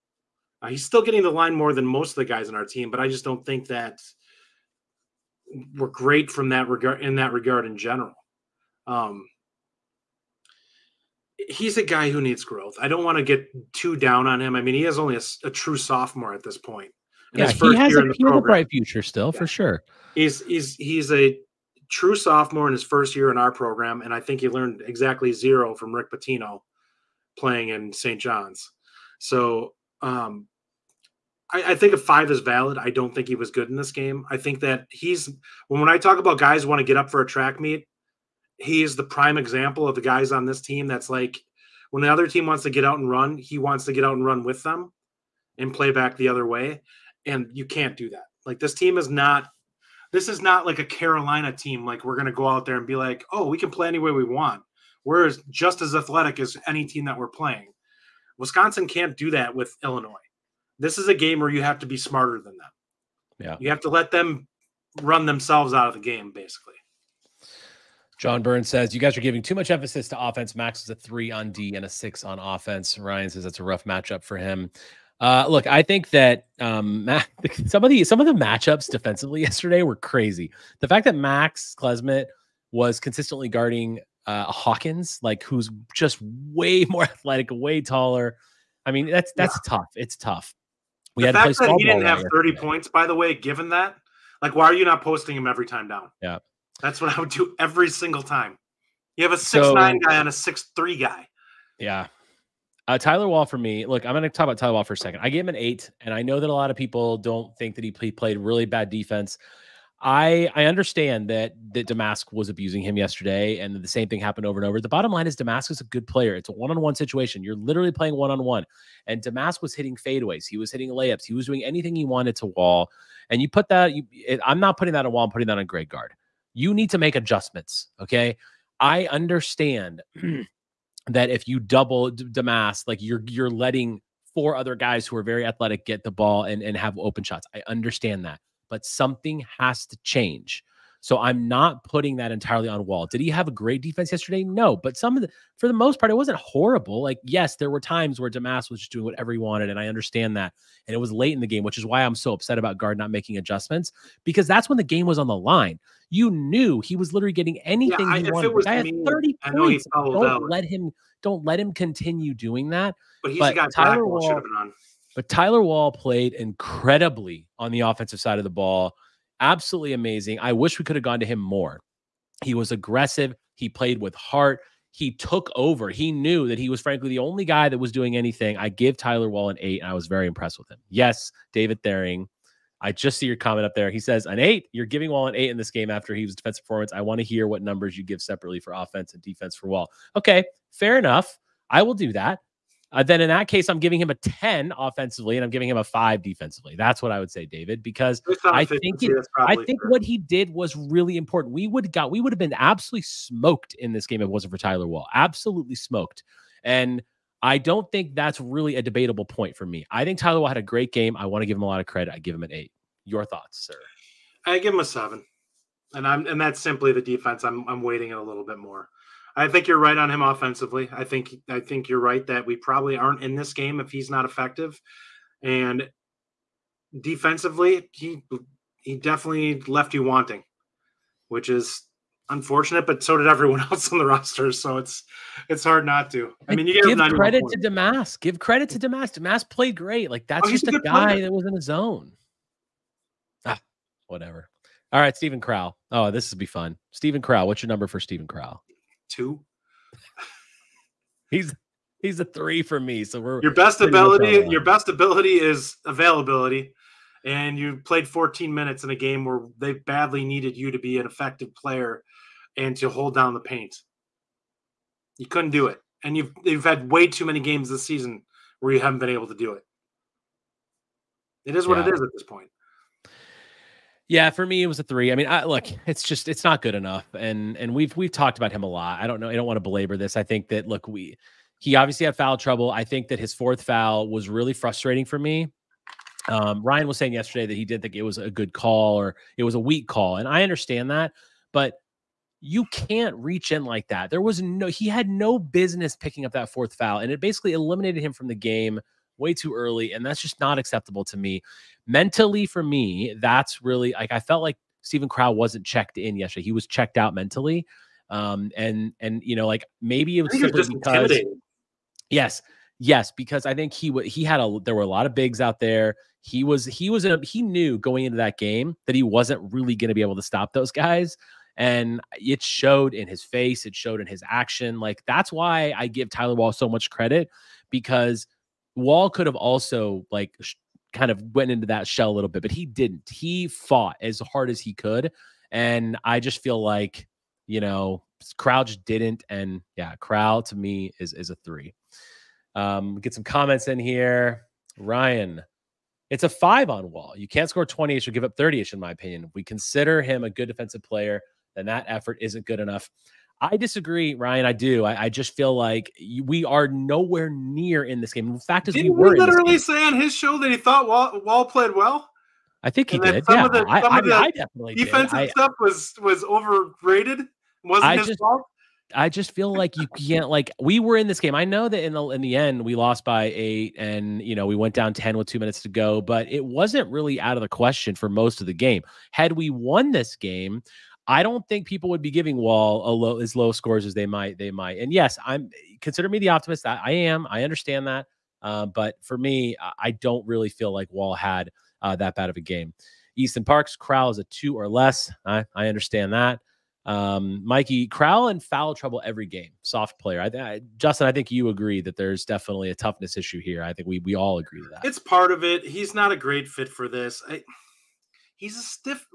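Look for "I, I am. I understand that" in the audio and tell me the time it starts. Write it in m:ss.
6:26.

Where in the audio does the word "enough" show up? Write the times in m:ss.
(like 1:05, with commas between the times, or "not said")
3:10, 4:36, 5:52.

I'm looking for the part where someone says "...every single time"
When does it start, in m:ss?
1:37.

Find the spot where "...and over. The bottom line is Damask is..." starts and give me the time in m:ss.
1:54.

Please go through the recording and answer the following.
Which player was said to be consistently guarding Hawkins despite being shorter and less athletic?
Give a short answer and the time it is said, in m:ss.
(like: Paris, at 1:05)
Max Klesmit, at 1:21.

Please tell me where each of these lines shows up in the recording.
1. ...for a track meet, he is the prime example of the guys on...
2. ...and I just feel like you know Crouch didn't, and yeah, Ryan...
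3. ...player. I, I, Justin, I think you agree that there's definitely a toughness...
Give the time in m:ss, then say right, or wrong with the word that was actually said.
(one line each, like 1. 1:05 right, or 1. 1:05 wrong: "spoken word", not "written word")
1. 0:37 right
2. 5:35 wrong: "Crowl", not "Ryan"
3. 6:39 right.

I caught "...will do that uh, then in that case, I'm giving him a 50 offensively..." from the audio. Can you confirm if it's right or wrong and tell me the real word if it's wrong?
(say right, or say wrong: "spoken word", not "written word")
wrong: "10", not "50".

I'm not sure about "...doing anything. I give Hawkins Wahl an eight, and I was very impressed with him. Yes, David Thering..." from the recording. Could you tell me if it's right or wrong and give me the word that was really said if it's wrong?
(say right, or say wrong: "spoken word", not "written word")
wrong: "Tyler", not "Hawkins".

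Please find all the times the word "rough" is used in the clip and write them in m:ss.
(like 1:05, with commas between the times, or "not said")
1:13.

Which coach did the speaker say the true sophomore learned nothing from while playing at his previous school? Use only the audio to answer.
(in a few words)
Rick Pitino.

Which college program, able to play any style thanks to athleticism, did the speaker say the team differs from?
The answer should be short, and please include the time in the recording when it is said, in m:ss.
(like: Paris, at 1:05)
Carolina, at 0:50.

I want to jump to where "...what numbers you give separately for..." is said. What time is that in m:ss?
3:07.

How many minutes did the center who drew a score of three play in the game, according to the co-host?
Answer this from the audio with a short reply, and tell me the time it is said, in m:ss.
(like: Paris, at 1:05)
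14, at 4:18.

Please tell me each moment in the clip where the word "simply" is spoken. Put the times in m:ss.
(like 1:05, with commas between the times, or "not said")
3:36, 5:10.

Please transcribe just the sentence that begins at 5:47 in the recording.
You can't score 20ish or give up 30ish, in my opinion.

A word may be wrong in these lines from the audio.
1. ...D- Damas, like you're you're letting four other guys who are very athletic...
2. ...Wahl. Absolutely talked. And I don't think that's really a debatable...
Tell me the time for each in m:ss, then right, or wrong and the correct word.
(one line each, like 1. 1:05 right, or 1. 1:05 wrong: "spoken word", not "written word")
1. 2:12 right
2. 3:24 wrong: "smoked", not "talked".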